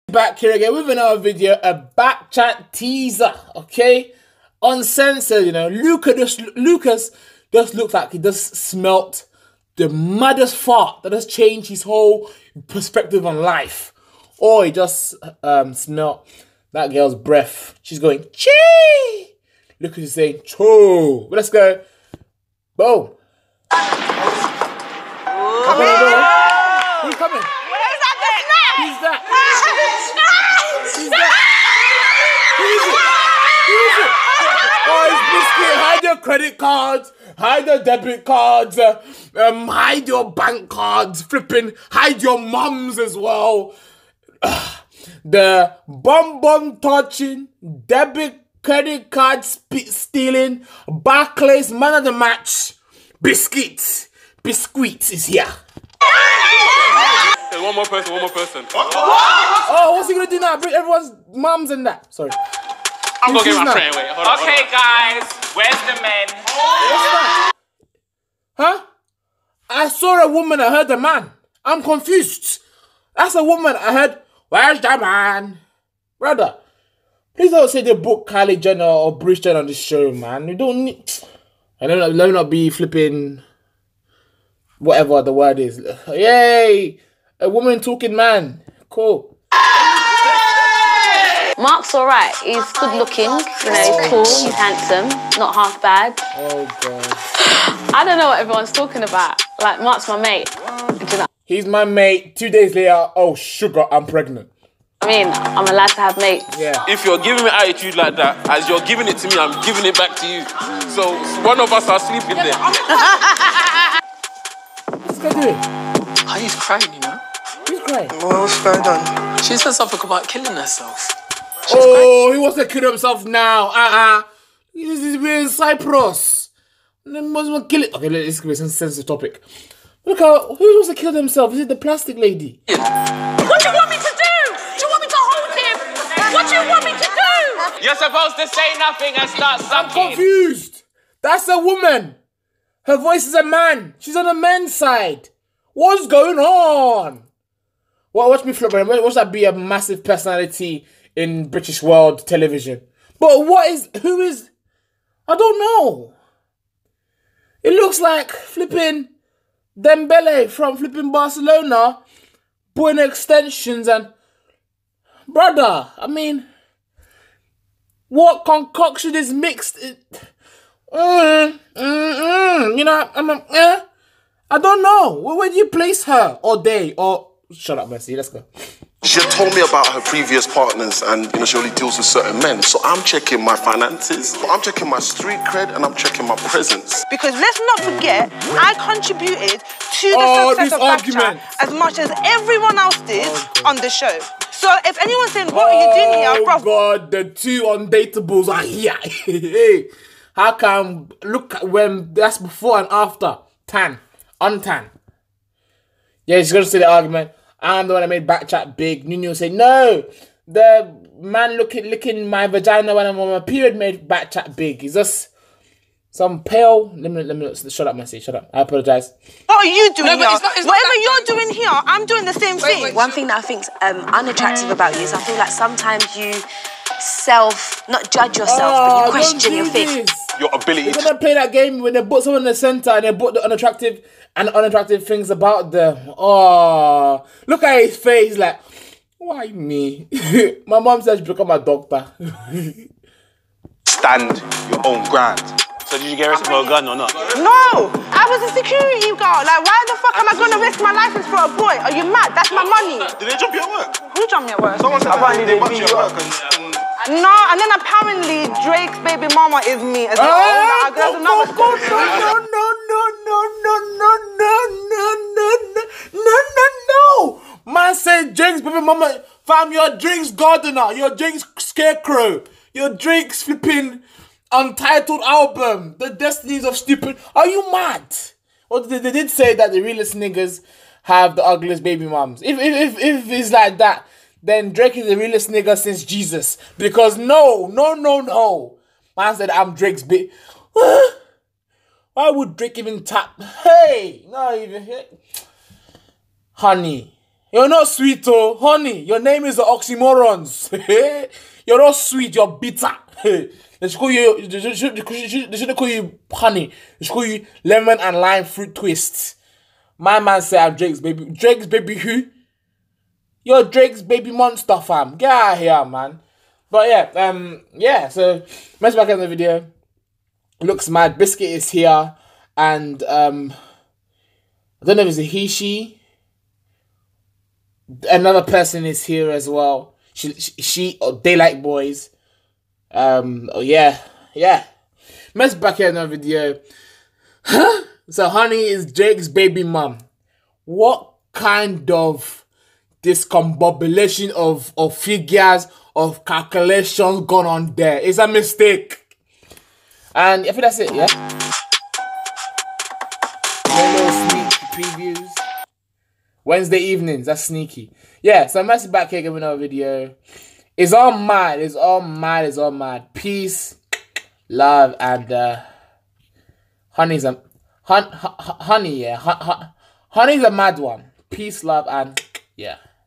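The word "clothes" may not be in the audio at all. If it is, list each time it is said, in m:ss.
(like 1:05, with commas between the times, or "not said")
not said.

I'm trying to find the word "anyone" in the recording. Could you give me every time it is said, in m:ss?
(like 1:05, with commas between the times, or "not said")
3:15.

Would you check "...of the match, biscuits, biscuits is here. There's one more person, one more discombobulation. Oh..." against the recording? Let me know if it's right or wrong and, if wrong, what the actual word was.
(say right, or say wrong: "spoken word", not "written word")
wrong: "person", not "discombobulation".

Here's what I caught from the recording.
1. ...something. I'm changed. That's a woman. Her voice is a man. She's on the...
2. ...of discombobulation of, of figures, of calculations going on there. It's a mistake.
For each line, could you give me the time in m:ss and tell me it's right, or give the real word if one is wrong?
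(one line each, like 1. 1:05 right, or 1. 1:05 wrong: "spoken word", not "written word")
1. 2:19 wrong: "confused", not "changed"
2. 5:41 right.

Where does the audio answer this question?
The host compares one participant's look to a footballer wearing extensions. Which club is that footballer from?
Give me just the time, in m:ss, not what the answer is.
2:41.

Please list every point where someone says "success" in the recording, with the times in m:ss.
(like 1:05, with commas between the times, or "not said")
3:10.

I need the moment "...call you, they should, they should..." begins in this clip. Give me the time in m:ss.
5:03.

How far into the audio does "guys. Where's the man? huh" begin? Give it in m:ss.
1:05.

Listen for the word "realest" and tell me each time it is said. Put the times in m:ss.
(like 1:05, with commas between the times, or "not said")
4:39, 4:45.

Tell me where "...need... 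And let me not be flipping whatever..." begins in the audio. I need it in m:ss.
1:20.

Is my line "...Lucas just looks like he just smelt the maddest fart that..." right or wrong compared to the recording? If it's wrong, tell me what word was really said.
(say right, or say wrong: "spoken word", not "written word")
right.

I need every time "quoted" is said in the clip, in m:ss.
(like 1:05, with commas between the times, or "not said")
not said.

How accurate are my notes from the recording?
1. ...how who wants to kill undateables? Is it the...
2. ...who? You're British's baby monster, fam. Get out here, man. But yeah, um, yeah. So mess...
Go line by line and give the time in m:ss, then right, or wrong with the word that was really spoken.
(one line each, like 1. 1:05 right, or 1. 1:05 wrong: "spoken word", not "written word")
1. 2:10 wrong: "themselves", not "undateables"
2. 5:11 wrong: "Drake", not "British".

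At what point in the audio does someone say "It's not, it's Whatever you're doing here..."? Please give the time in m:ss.
3:40.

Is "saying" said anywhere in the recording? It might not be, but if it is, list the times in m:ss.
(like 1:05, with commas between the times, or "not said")
0:20, 3:15.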